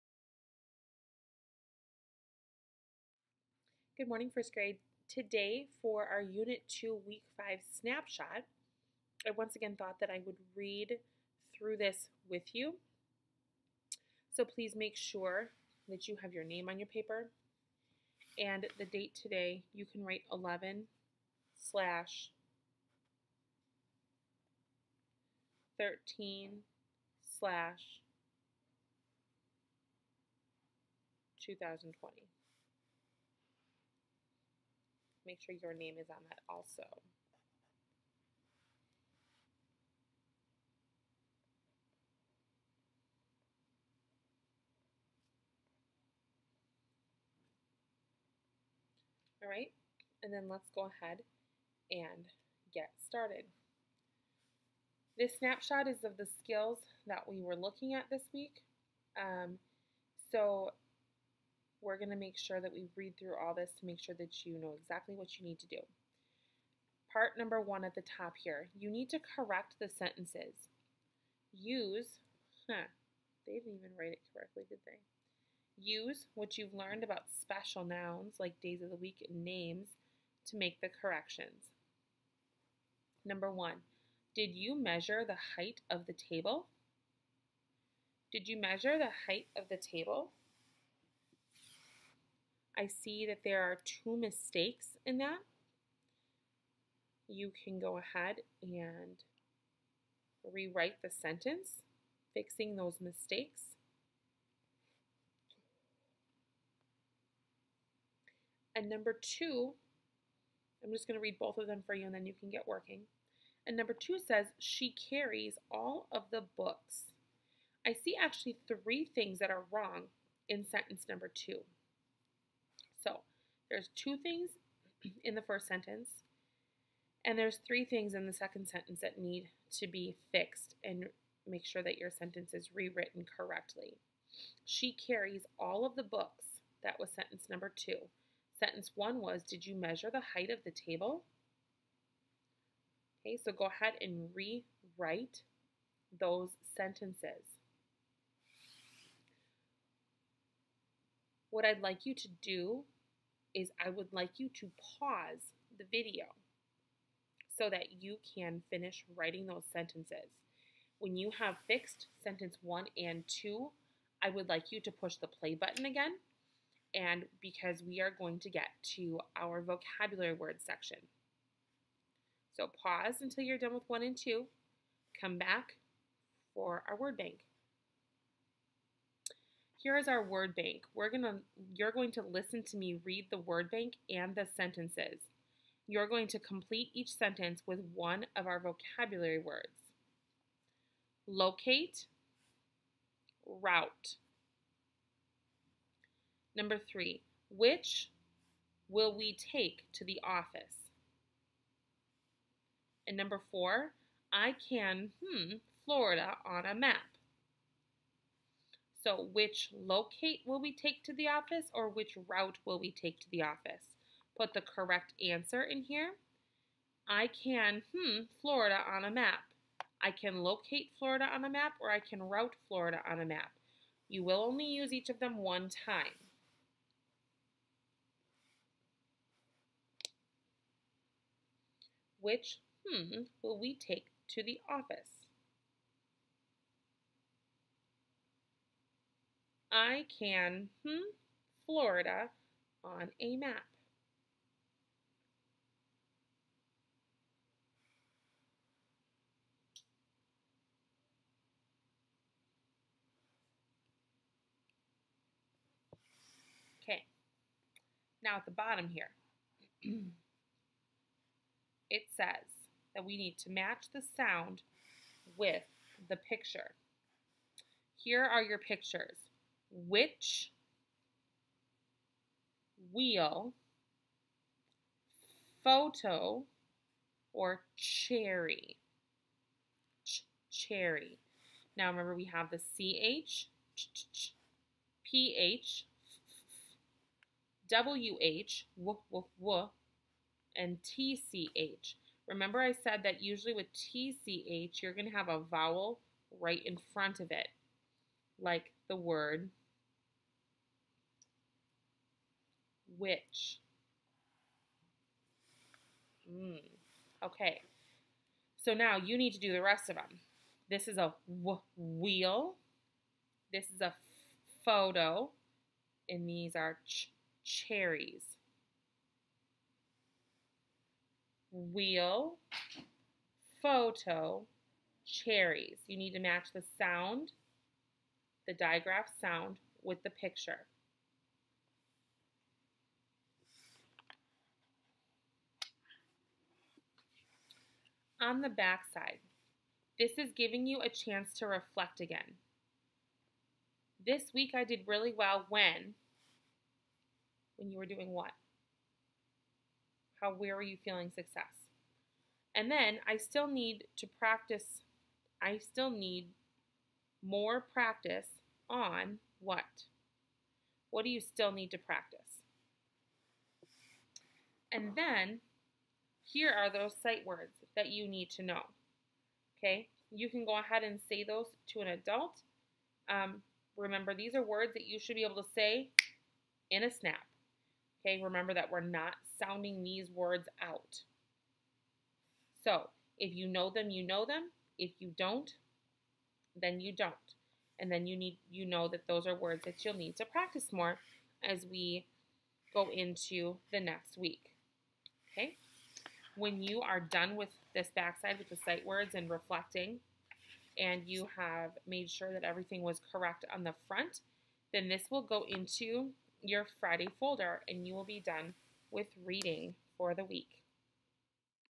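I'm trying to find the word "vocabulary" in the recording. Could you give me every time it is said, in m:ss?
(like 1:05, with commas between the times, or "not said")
2:49, 3:08.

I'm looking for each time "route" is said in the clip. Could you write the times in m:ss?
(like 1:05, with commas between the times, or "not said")
3:13, 3:32, 3:42.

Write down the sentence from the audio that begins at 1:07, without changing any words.
Part number one at the top here, you need to correct the sentences.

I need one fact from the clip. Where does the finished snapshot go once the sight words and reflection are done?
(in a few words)
Friday folder.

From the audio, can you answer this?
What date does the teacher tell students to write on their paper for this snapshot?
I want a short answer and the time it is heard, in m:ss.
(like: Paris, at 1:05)
11/13/2020, at 0:20.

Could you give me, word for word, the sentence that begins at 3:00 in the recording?
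We're gonna, you're going to listen to me read the word bank and the sentences.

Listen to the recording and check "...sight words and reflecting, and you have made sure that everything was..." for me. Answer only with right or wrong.
right.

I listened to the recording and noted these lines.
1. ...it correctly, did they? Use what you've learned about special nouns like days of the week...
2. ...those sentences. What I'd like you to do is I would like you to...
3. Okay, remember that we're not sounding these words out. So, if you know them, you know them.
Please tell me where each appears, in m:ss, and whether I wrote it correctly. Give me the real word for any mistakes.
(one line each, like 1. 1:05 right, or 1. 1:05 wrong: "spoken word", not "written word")
1. 1:14 right
2. 2:26 right
3. 6:18 right.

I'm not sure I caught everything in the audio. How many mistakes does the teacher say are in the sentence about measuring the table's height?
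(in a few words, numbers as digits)
2.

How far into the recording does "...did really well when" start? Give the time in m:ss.
5:44.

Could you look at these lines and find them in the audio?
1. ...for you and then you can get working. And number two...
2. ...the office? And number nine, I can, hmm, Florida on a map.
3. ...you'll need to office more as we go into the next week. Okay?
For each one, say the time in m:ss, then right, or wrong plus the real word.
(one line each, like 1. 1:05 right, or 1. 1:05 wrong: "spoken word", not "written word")
1. 1:51 right
2. 3:20 wrong: "four", not "nine"
3. 6:29 wrong: "practice", not "office".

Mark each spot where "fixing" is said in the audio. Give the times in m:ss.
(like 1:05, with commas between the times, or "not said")
1:42.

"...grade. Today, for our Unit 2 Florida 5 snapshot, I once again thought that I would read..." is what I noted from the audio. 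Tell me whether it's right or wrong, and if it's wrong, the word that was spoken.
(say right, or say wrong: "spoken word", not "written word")
wrong: "Week", not "Florida".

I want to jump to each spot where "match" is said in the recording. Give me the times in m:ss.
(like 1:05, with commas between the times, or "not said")
4:23, 5:26.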